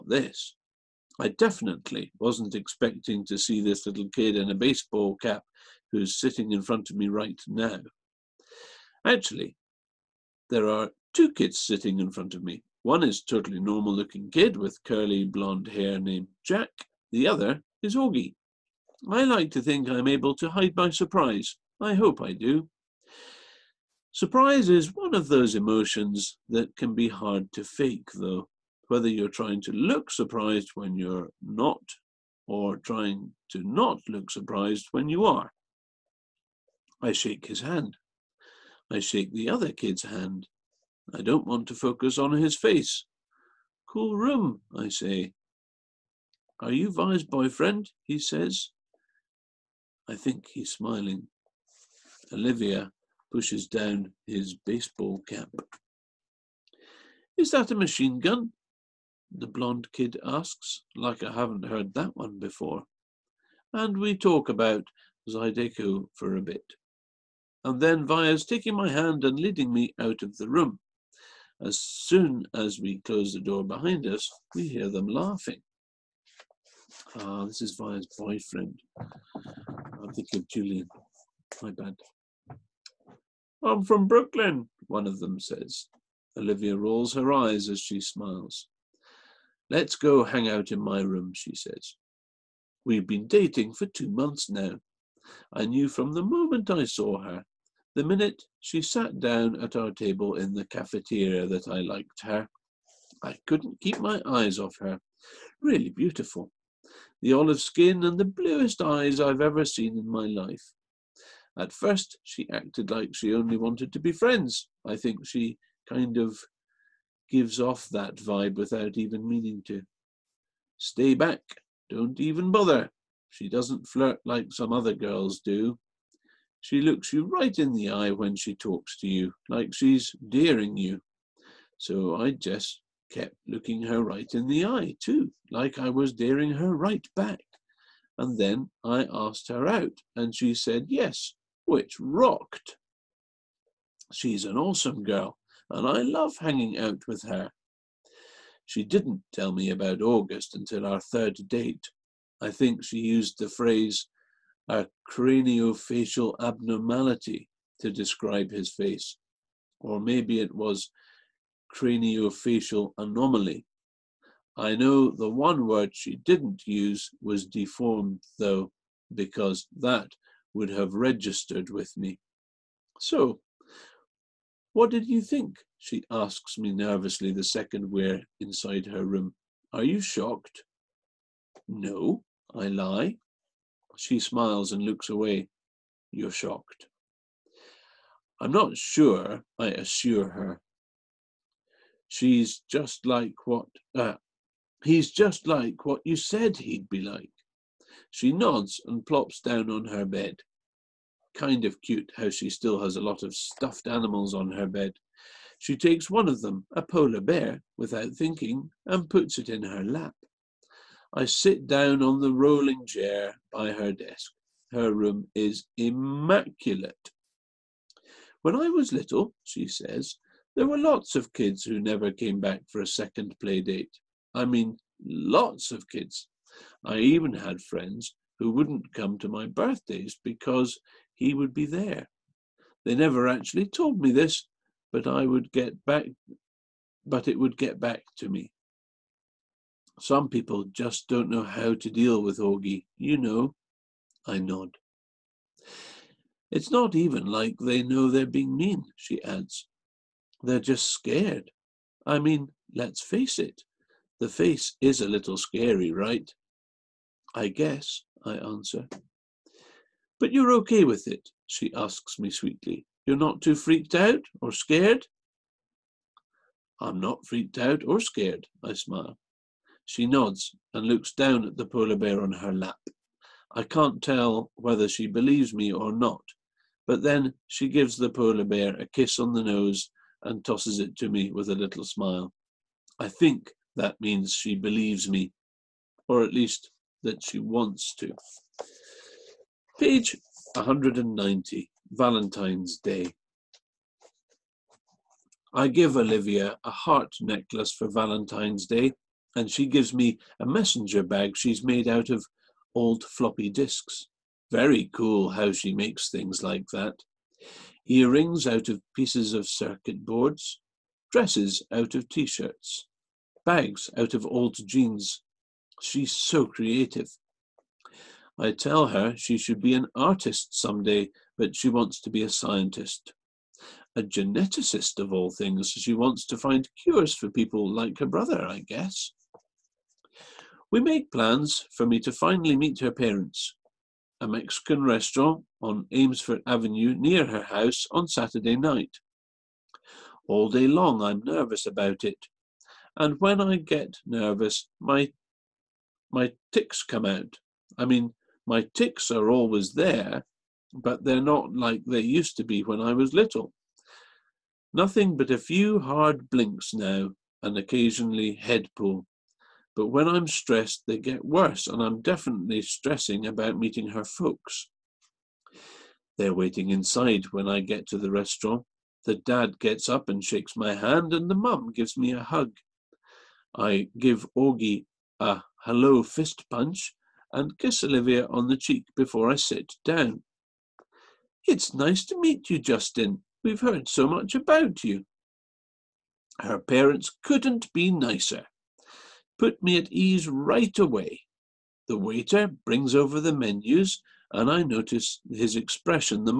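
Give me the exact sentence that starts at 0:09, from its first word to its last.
Actually, there are two kids sitting in front of me.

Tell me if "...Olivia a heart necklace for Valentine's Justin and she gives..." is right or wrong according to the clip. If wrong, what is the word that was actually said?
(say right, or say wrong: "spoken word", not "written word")
wrong: "Day", not "Justin".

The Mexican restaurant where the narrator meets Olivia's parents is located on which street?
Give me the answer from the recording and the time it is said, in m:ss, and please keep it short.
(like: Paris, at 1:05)
Amesfort Avenue, at 5:35.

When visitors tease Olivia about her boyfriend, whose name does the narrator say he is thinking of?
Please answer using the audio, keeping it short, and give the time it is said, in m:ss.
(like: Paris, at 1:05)
Julian, at 1:20.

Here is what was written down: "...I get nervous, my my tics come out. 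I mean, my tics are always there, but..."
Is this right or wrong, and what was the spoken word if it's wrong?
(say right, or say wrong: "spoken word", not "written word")
right.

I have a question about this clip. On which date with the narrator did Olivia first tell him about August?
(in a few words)
Third date.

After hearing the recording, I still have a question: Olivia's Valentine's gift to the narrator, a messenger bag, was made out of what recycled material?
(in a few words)
Old floppy disks.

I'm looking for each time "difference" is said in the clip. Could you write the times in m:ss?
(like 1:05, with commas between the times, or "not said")
not said.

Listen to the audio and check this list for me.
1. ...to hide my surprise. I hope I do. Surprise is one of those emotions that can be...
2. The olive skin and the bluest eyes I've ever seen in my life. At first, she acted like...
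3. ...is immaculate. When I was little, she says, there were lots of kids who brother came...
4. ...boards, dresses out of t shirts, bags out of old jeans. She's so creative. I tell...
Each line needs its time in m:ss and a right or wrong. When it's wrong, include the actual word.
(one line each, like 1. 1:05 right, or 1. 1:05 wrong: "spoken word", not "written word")
1. 0:20 right
2. 1:47 right
3. 3:35 wrong: "never", not "brother"
4. 5:10 right.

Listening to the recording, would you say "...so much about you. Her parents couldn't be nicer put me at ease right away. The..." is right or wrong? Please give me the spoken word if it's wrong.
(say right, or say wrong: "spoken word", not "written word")
right.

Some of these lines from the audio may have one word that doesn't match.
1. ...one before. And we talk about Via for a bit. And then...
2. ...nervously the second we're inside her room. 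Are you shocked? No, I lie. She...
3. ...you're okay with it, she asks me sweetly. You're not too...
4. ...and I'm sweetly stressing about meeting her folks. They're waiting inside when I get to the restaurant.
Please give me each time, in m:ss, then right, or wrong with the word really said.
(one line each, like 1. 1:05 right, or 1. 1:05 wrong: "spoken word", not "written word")
1. 1:02 wrong: "Zydeco", not "Via"
2. 2:56 right
3. 4:20 right
4. 6:01 wrong: "definitely", not "sweetly".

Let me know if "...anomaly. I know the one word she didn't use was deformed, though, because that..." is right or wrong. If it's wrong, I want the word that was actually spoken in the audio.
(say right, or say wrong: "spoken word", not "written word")
right.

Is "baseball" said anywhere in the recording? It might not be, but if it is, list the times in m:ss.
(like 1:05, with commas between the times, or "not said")
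0:04, 0:54.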